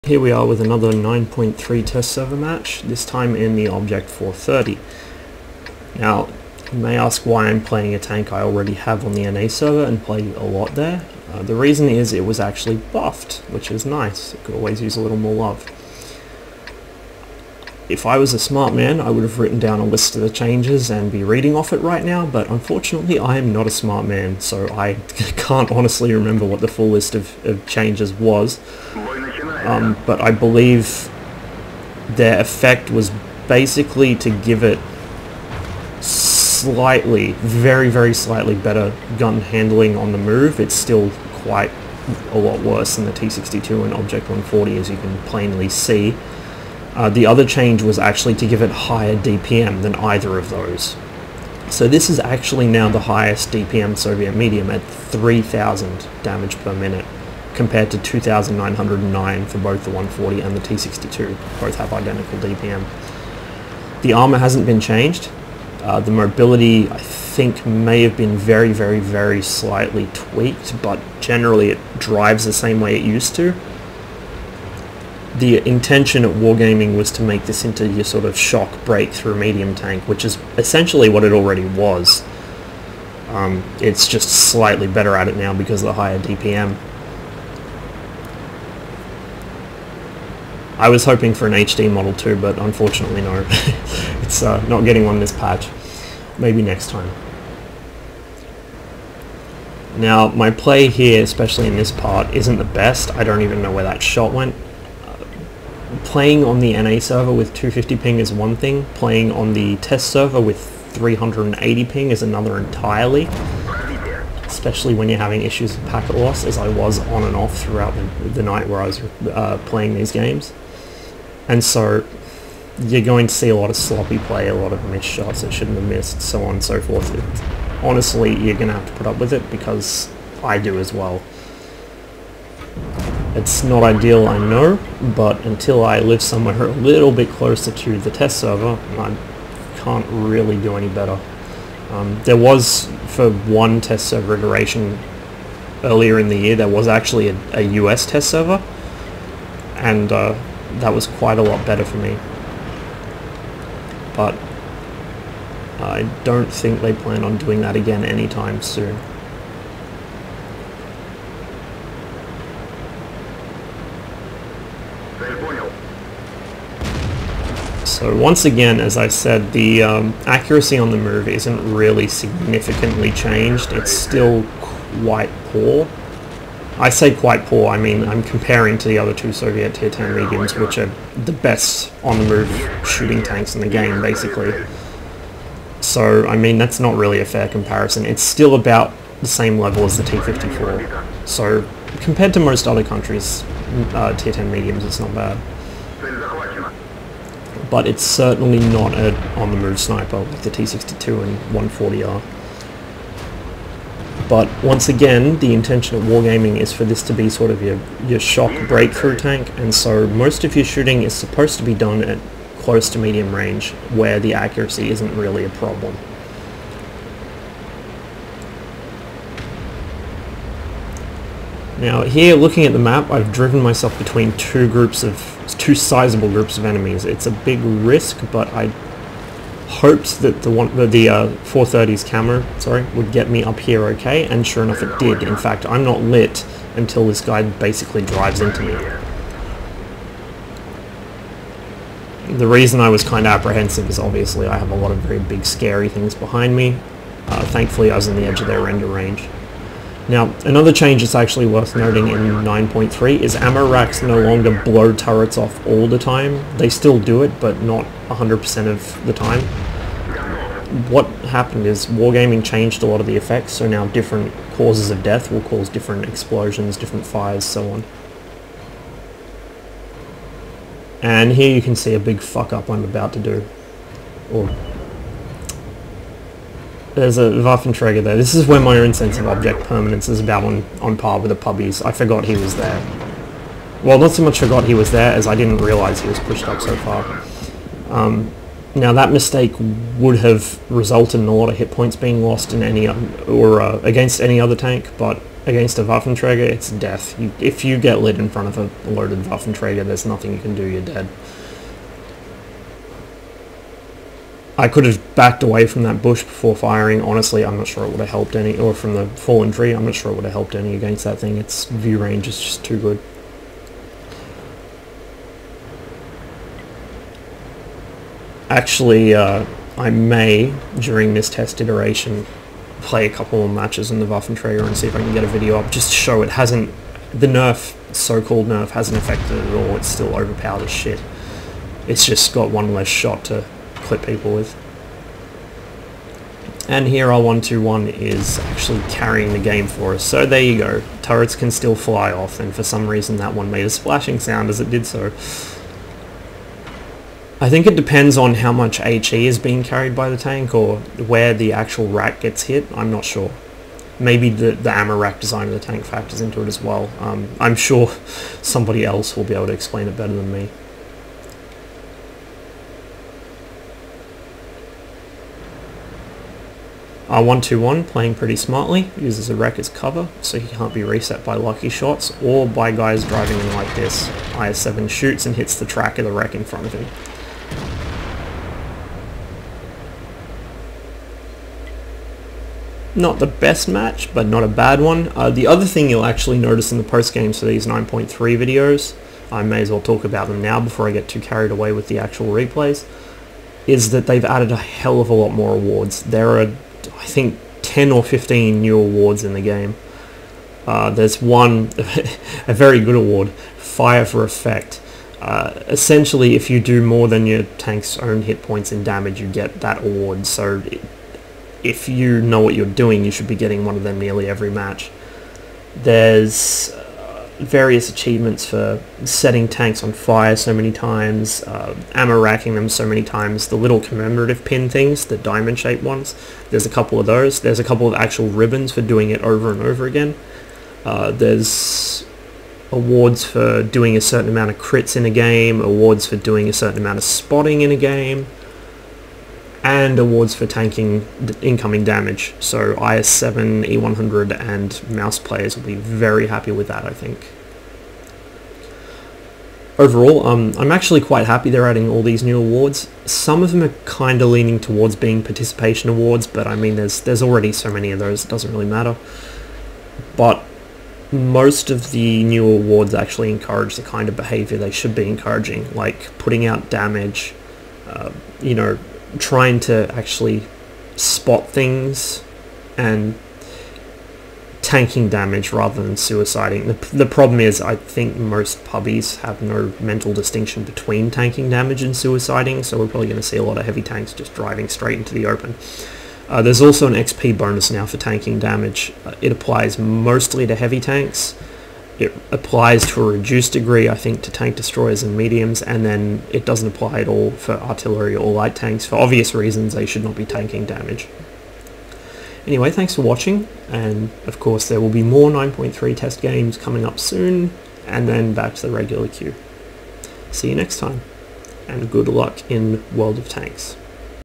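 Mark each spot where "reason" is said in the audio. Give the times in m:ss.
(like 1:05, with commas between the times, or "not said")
0:11, 4:02, 5:42, 8:19.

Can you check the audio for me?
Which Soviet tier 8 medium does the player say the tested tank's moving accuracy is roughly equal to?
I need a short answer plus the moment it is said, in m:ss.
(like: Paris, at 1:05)
T-54, at 3:10.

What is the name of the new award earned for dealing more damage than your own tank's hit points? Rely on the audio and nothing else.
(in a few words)
Fire for Effect.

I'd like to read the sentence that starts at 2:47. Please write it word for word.
So once again, as I said, the um, accuracy on the move isn't really significantly changed.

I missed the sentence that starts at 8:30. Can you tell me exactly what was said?
See you next time, and good luck in World of Tanks.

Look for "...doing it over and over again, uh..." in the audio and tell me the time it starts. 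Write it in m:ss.
7:08.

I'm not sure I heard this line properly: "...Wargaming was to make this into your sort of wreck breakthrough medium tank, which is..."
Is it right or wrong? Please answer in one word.
wrong.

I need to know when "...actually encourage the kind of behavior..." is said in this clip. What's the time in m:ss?
7:42.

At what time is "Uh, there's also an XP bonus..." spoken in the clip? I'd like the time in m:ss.
8:06.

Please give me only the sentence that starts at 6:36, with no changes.
There are I think 10 or 15 new awards in the game.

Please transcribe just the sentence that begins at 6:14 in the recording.
IS-7 shoots and hits the track of the wreck in front of him.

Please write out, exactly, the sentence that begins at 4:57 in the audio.
You, if you get lit in front of a loaded Waffenträger, there's nothing you can do.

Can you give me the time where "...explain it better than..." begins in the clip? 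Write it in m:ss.
5:59.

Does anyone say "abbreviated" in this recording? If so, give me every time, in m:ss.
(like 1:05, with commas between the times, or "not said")
not said.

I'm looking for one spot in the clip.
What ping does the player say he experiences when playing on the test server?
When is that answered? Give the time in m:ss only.
1:50.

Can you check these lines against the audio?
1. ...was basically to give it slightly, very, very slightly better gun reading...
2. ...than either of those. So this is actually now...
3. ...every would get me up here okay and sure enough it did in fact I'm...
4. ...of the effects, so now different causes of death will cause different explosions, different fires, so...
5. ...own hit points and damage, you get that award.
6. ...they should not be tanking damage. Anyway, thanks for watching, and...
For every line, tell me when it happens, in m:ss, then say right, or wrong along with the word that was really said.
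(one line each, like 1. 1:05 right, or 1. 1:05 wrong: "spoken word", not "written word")
1. 0:32 wrong: "handling", not "reading"
2. 0:49 right
3. 3:52 wrong: "sorry", not "every"
4. 4:22 right
5. 6:47 right
6. 8:19 right.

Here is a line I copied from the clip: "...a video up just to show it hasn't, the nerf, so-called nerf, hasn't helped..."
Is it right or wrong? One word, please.
wrong.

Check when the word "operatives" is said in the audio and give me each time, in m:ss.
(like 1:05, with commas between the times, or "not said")
not said.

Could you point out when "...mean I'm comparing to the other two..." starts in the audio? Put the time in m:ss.
2:57.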